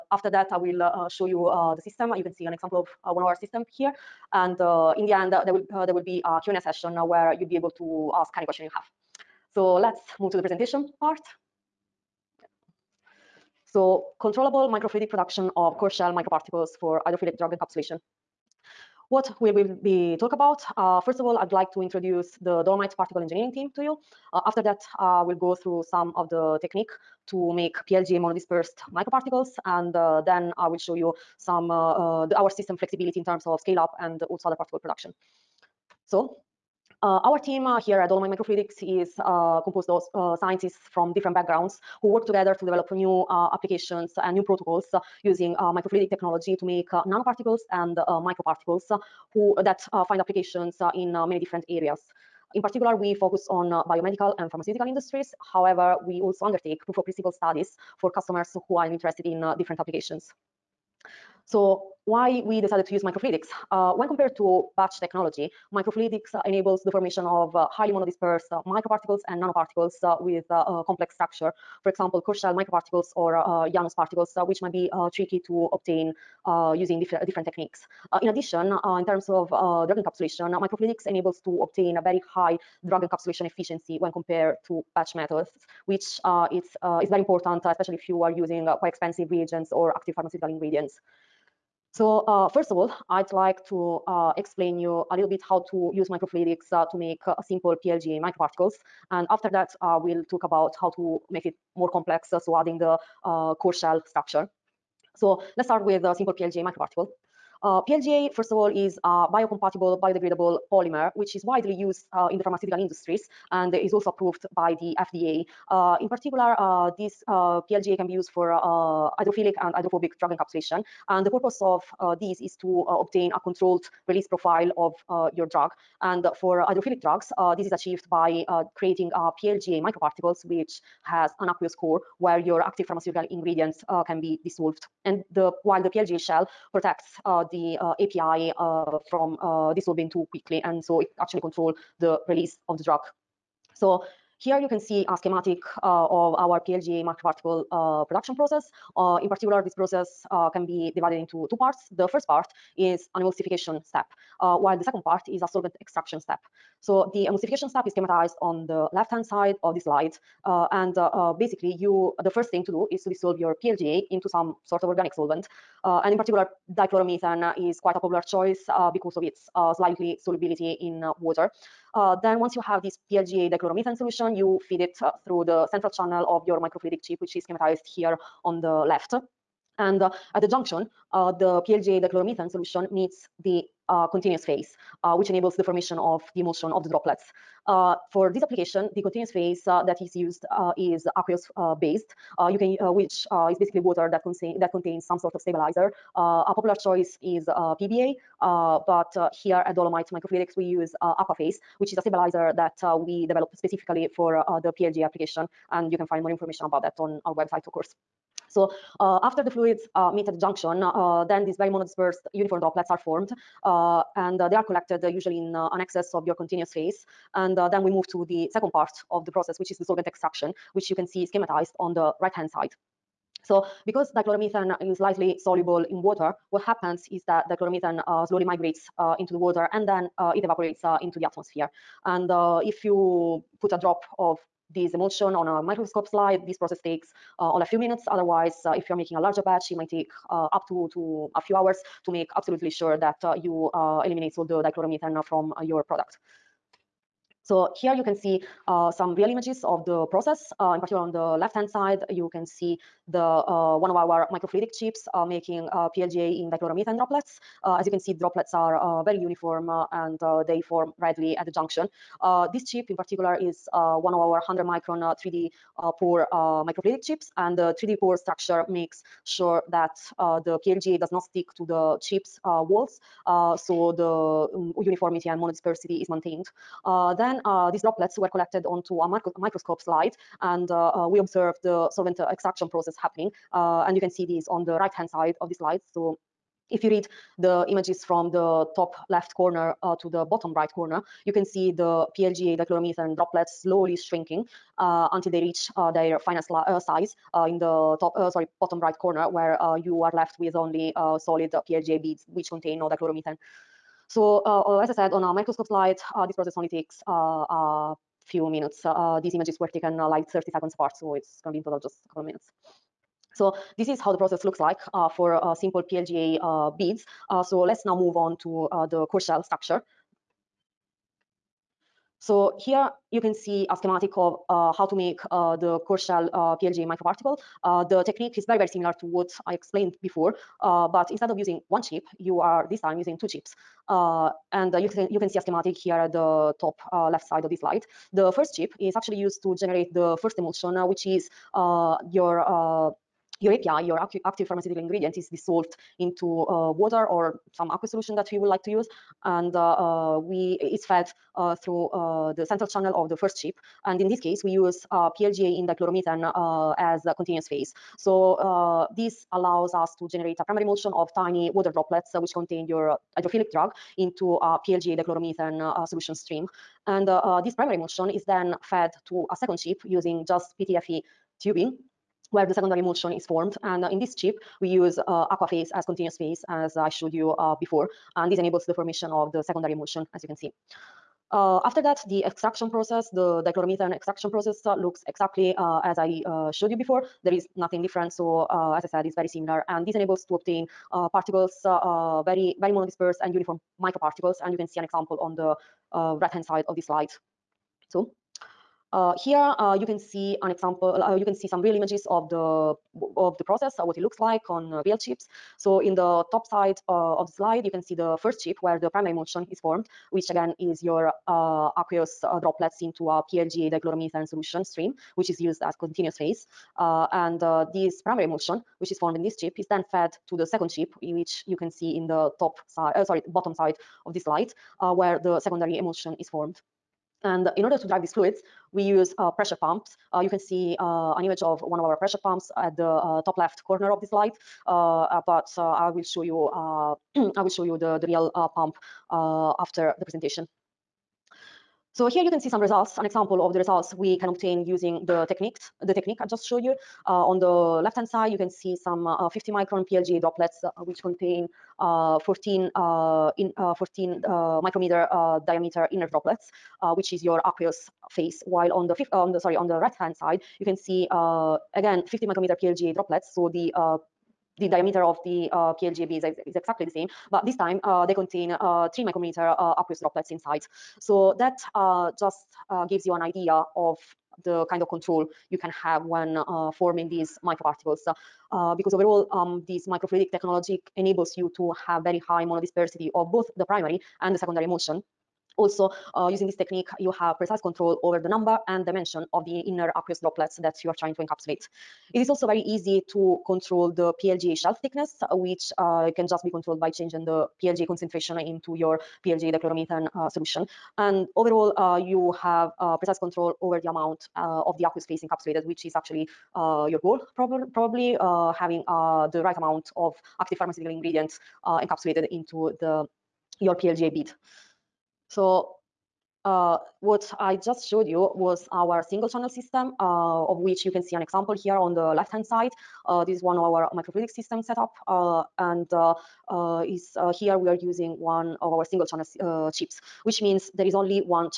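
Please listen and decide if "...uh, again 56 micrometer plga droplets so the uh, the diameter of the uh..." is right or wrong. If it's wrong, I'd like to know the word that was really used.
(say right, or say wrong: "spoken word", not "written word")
wrong: "50", not "56".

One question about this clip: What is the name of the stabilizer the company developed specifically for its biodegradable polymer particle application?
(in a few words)
Aquaphase.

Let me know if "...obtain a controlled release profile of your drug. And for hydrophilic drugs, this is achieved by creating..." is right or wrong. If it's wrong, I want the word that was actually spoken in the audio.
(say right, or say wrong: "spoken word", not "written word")
right.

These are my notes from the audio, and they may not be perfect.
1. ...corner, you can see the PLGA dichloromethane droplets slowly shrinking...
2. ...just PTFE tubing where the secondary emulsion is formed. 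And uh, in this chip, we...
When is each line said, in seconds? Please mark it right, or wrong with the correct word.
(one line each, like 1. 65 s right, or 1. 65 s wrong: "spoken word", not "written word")
1. 290 s right
2. 370 s right.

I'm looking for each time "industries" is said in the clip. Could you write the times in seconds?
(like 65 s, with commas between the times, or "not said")
54 s, 112 s.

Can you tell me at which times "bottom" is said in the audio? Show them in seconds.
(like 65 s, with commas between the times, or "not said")
290 s, 298 s, 423 s.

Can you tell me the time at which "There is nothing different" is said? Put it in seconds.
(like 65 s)
387 s.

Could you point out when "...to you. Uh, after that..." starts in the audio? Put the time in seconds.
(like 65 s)
23 s.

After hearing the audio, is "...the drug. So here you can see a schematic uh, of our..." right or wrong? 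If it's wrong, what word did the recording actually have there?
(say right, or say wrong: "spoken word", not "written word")
right.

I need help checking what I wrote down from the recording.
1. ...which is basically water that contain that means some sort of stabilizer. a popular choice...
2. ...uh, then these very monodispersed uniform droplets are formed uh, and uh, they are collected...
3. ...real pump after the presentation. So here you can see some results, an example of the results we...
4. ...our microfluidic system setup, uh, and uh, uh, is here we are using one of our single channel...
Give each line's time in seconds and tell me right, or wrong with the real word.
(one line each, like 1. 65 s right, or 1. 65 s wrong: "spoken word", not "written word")
1. 192 s wrong: "contains", not "means"
2. 210 s right
3. 438 s right
4. 523 s right.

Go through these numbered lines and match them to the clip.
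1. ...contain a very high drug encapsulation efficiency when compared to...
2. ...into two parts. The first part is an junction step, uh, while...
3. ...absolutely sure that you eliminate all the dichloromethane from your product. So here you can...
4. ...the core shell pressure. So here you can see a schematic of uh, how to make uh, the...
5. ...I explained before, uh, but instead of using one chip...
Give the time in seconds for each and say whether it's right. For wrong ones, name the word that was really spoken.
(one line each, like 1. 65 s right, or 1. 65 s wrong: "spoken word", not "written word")
1. 81 s wrong: "obtain", not "contain"
2. 151 s wrong: "emulsification", not "junction"
3. 242 s right
4. 318 s wrong: "structure", not "pressure"
5. 329 s right.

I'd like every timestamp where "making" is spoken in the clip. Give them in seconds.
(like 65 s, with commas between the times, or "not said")
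238 s, 255 s.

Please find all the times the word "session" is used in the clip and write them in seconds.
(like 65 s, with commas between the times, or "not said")
6 s.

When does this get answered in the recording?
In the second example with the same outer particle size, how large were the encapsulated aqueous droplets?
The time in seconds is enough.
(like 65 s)
468 s.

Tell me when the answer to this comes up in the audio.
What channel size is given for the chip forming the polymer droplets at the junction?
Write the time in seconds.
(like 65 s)
264 s.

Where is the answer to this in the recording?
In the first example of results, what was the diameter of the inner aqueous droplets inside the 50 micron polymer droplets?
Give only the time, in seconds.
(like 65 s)
453 s.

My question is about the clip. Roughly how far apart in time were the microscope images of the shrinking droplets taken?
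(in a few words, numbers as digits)
30 seconds.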